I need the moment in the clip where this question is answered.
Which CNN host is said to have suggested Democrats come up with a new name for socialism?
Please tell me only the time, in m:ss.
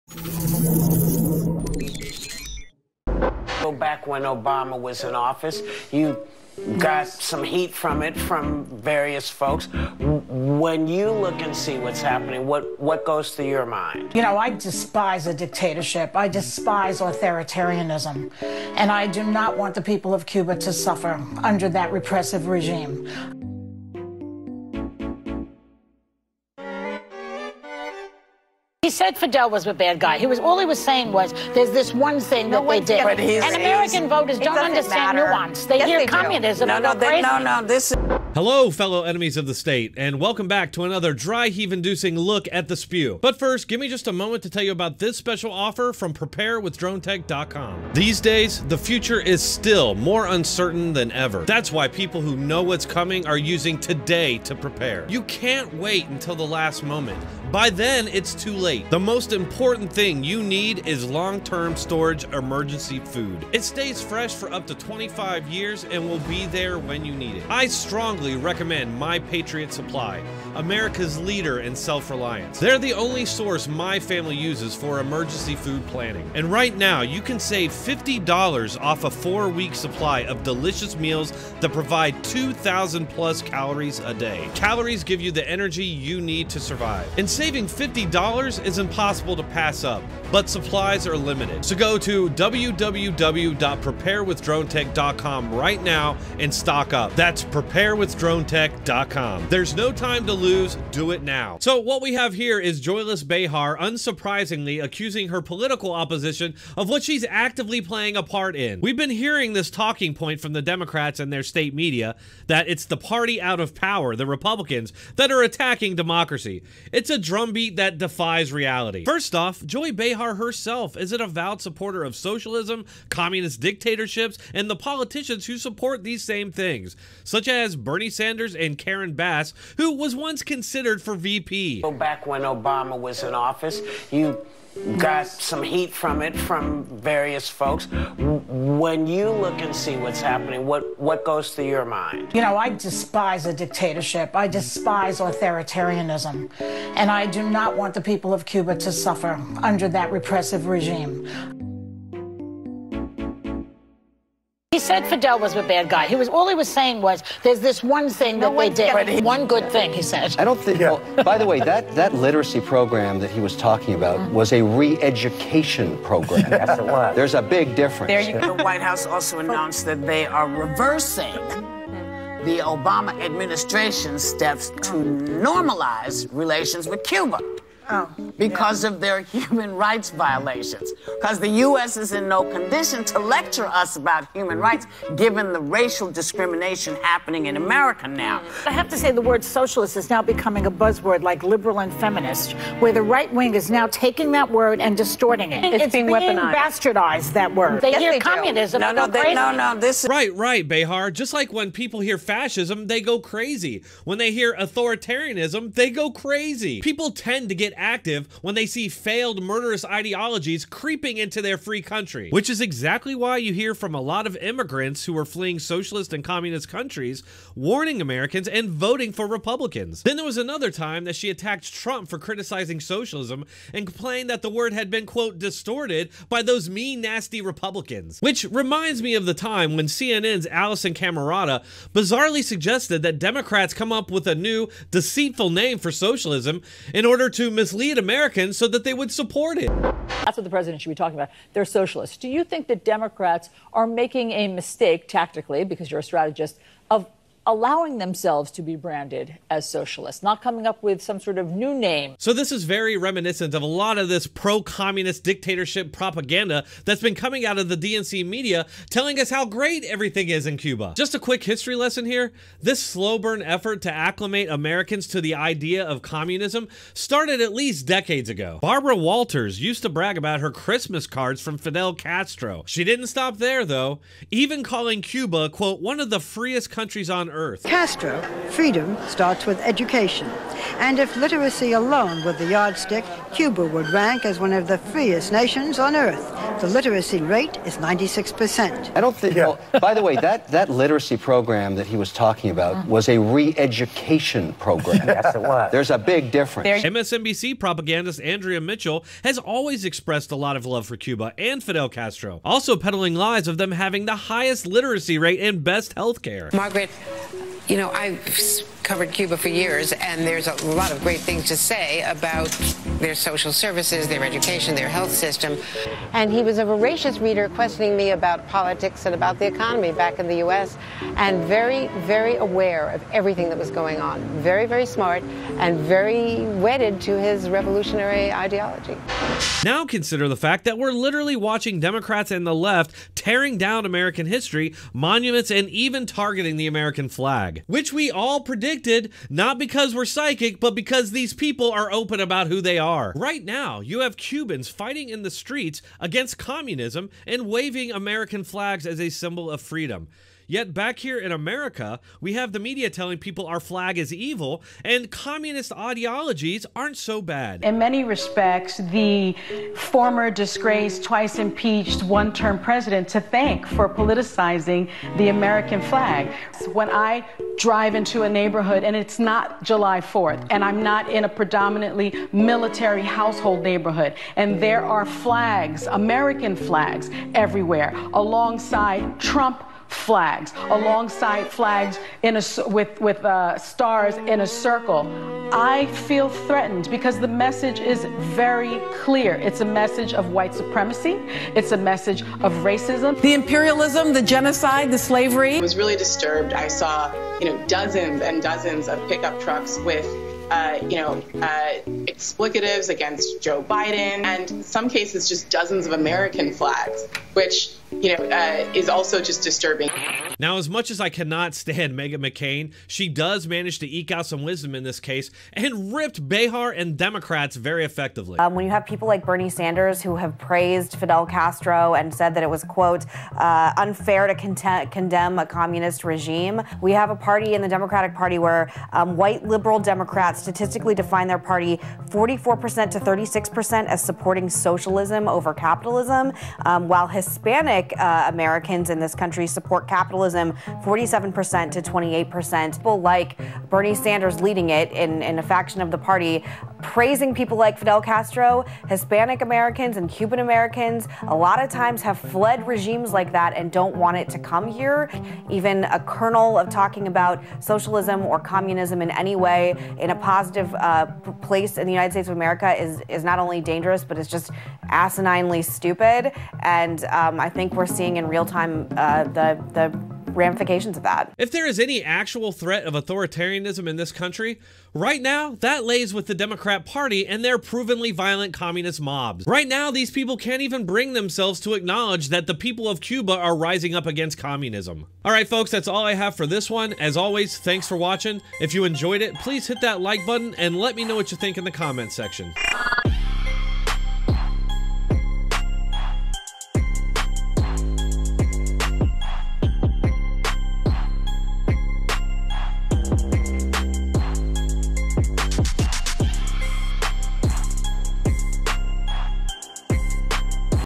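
3:50.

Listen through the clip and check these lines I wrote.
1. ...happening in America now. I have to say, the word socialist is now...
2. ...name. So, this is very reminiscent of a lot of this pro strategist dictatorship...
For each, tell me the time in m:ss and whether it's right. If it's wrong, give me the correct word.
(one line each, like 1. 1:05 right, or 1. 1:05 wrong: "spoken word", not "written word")
1. 3:07 right
2. 4:11 wrong: "communist", not "strategist".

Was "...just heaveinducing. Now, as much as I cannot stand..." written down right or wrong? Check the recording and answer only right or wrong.
wrong.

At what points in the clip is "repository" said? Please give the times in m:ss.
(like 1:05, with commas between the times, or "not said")
not said.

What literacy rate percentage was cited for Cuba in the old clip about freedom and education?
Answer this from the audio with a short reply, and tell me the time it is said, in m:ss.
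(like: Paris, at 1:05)
96%, at 4:47.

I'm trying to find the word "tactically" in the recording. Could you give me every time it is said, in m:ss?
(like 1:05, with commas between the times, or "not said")
4:05.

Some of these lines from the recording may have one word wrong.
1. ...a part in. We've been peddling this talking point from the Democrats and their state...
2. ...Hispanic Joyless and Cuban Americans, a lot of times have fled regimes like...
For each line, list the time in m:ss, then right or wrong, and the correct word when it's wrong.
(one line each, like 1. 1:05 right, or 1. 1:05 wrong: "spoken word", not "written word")
1. 1:48 wrong: "hearing", not "peddling"
2. 7:28 wrong: "Americans", not "Joyless".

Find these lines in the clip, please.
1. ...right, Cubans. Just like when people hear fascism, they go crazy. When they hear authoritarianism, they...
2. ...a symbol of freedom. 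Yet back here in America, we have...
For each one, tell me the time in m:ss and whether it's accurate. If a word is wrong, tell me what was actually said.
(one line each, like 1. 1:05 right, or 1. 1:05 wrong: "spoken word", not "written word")
1. 3:20 wrong: "Behar", not "Cubans"
2. 5:48 right.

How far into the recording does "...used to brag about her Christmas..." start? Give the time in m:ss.
4:29.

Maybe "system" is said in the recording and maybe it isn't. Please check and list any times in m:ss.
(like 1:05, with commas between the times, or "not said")
5:15.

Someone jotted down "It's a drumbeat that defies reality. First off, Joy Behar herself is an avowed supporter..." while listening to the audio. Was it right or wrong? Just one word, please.
right.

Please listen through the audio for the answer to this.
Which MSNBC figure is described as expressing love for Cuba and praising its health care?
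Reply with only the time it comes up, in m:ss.
4:58.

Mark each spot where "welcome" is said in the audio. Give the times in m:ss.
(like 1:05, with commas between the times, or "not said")
0:40.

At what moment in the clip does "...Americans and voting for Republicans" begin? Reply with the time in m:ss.
3:37.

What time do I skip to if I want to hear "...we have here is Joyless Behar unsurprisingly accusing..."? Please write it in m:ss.
1:42.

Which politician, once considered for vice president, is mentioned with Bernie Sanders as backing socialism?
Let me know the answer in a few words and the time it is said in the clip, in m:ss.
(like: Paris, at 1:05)
Karen Bass, at 2:08.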